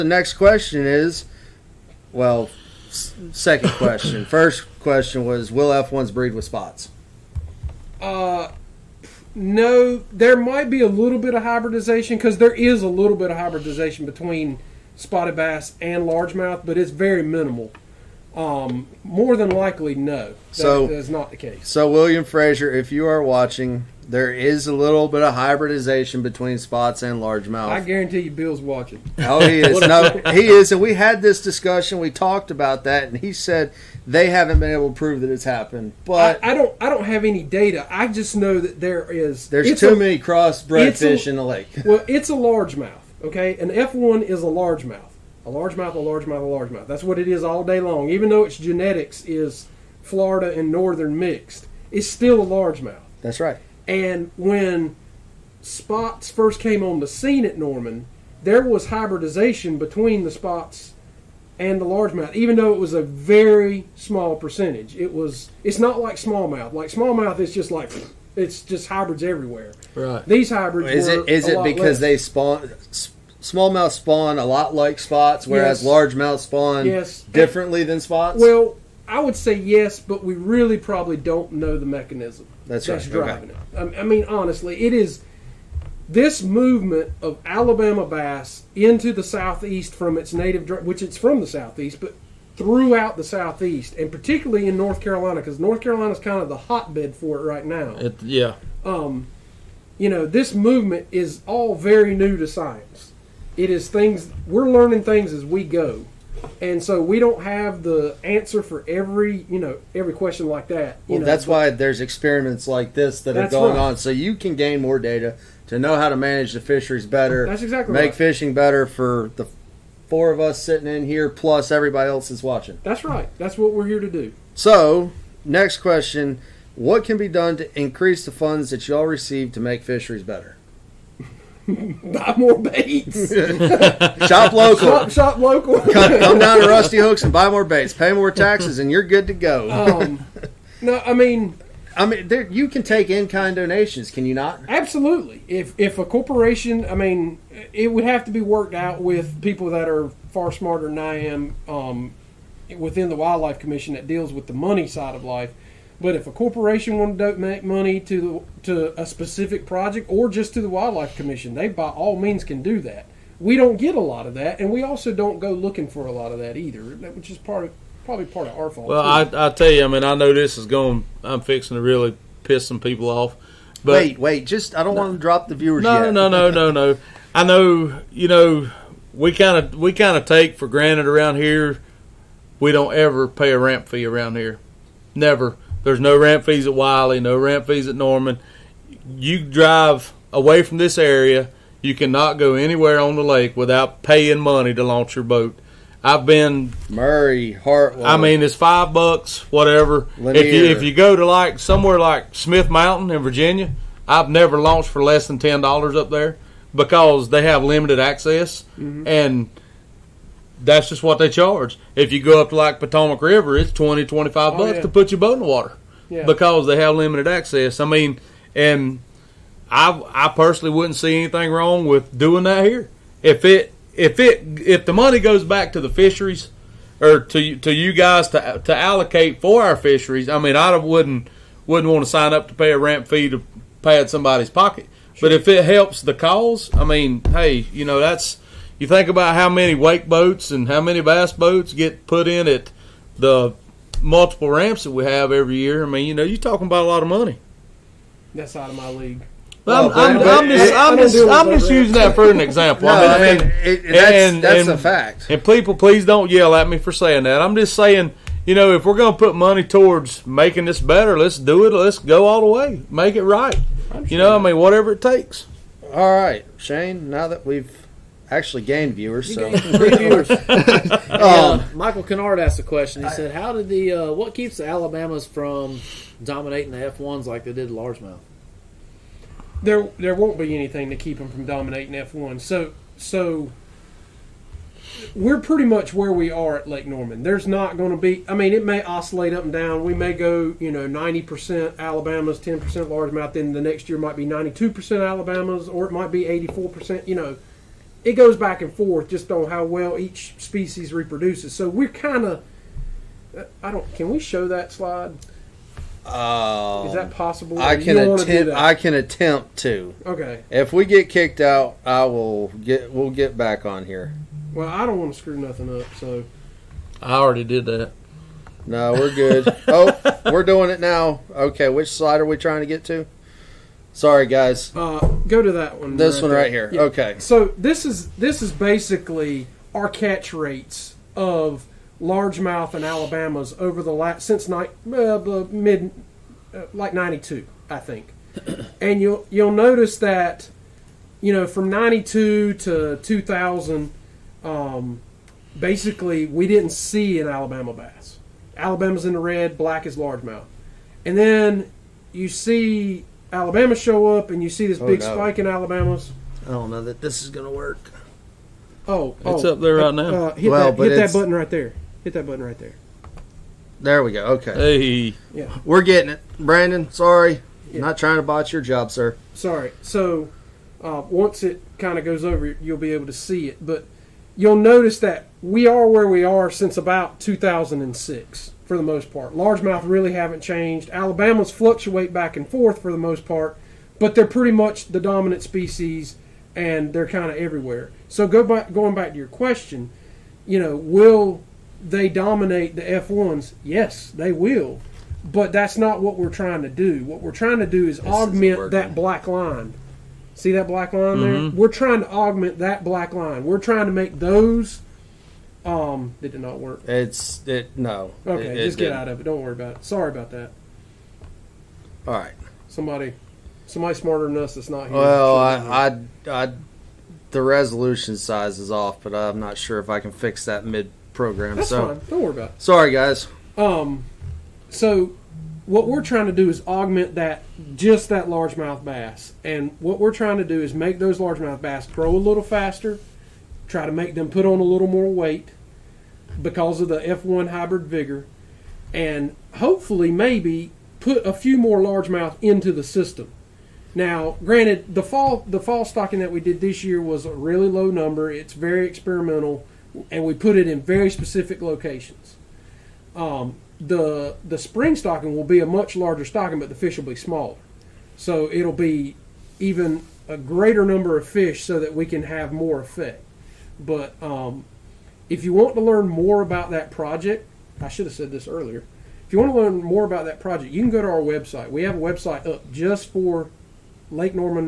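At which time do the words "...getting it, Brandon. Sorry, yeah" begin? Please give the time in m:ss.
6:05.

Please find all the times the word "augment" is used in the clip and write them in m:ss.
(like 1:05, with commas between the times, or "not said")
6:38, 6:42, 7:06.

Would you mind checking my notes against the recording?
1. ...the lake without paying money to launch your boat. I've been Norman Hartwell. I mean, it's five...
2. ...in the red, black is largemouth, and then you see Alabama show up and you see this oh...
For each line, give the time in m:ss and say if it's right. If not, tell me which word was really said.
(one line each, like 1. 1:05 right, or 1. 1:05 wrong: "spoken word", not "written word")
1. 3:13 wrong: "Murray", not "Norman"
2. 5:49 right.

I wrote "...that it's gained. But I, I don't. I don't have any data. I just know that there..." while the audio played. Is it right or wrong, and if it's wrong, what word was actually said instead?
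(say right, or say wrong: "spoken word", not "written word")
wrong: "happened", not "gained".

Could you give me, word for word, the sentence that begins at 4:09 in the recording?
Well, I'm, I'm, I'm, just, I'm just, I'm just using that for an example.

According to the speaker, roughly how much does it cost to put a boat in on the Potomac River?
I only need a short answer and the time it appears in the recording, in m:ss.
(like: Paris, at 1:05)
20 to 25 dollars, at 3:33.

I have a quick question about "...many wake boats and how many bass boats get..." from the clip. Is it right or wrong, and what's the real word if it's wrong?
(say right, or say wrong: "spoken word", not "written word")
right.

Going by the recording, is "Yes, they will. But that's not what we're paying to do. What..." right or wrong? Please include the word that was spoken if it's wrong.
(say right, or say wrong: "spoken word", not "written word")
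wrong: "trying", not "paying".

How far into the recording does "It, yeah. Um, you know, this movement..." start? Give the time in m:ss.
1:37.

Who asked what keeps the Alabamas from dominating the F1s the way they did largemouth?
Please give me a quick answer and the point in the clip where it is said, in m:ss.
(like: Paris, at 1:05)
Michael Kennard, at 4:31.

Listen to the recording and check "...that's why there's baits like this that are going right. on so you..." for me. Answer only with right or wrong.
wrong.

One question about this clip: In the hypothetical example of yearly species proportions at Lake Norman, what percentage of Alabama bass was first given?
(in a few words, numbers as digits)
90%.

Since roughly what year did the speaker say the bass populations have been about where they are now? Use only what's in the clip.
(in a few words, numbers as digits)
2006.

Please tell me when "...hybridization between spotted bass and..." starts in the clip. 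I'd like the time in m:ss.
0:13.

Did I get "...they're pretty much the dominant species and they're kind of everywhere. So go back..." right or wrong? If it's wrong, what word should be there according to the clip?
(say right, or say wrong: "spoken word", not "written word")
right.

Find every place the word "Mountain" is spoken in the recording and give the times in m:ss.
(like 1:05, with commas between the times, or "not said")
3:22.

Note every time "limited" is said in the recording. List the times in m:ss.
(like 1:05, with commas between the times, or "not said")
3:27, 3:36.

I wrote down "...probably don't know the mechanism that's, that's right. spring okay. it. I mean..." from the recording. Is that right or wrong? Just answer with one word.
wrong.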